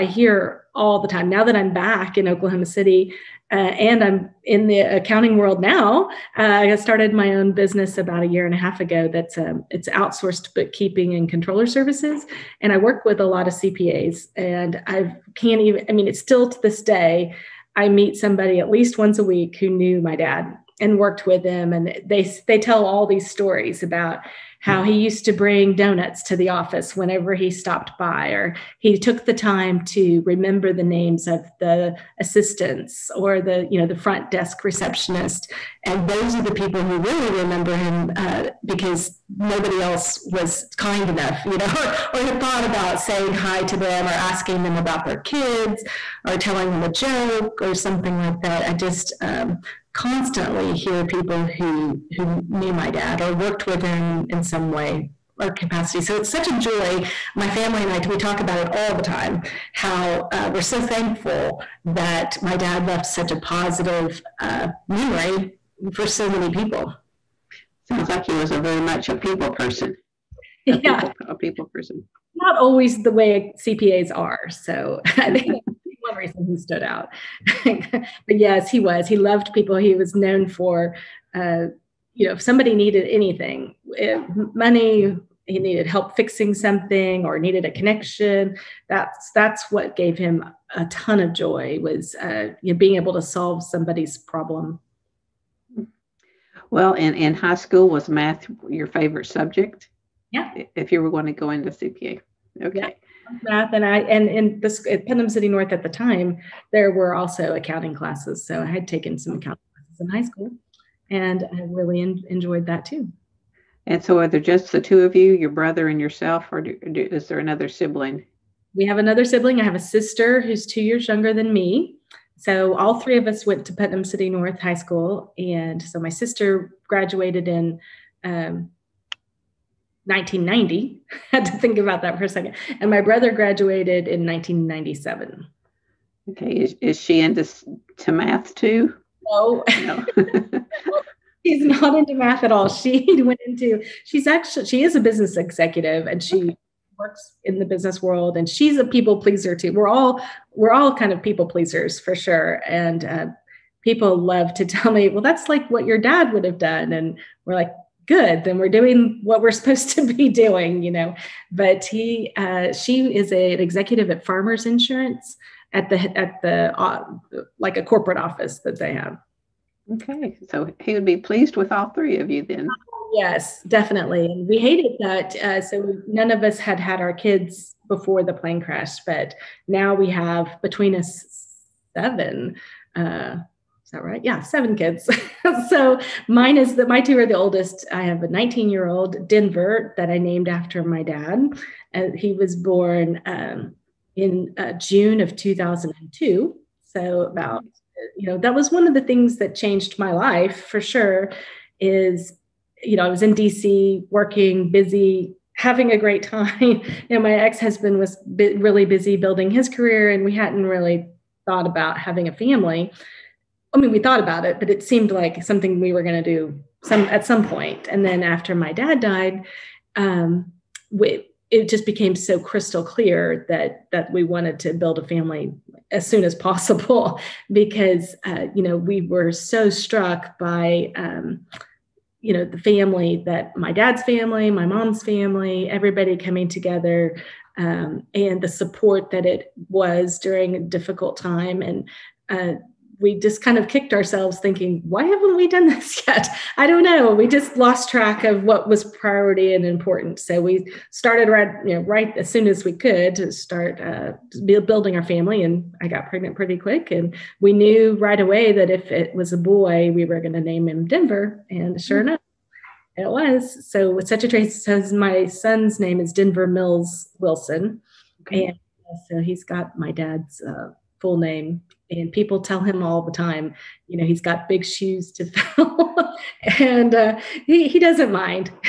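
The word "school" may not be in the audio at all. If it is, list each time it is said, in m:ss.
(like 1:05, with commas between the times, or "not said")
1:37, 1:50, 2:04.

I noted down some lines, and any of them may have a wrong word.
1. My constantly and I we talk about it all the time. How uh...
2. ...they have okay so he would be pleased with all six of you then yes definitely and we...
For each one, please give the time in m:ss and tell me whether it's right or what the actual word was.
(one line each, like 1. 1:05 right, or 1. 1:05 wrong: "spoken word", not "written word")
1. 0:57 wrong: "family", not "constantly"
2. 2:48 wrong: "three", not "six".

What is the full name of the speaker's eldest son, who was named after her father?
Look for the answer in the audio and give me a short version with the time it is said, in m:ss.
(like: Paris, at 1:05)
Denver Mills Wilson, at 4:26.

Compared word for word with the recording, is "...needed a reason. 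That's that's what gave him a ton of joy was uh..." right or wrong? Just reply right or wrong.
wrong.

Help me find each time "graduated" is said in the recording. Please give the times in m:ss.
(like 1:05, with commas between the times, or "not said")
2:06, 2:13.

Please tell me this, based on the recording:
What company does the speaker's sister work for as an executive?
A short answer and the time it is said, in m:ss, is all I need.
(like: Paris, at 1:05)
Farmers Insurance, at 2:44.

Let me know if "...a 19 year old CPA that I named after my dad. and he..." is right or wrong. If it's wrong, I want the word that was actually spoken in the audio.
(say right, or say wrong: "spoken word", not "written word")
wrong: "Denver", not "CPA".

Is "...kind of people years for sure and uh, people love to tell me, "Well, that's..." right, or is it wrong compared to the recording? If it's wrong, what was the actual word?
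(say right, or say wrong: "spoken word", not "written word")
wrong: "pleasers", not "years".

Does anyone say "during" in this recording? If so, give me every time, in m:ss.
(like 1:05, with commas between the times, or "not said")
4:00.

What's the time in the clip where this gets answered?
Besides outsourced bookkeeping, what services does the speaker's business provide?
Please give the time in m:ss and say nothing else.
0:11.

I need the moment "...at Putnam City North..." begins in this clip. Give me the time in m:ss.
1:44.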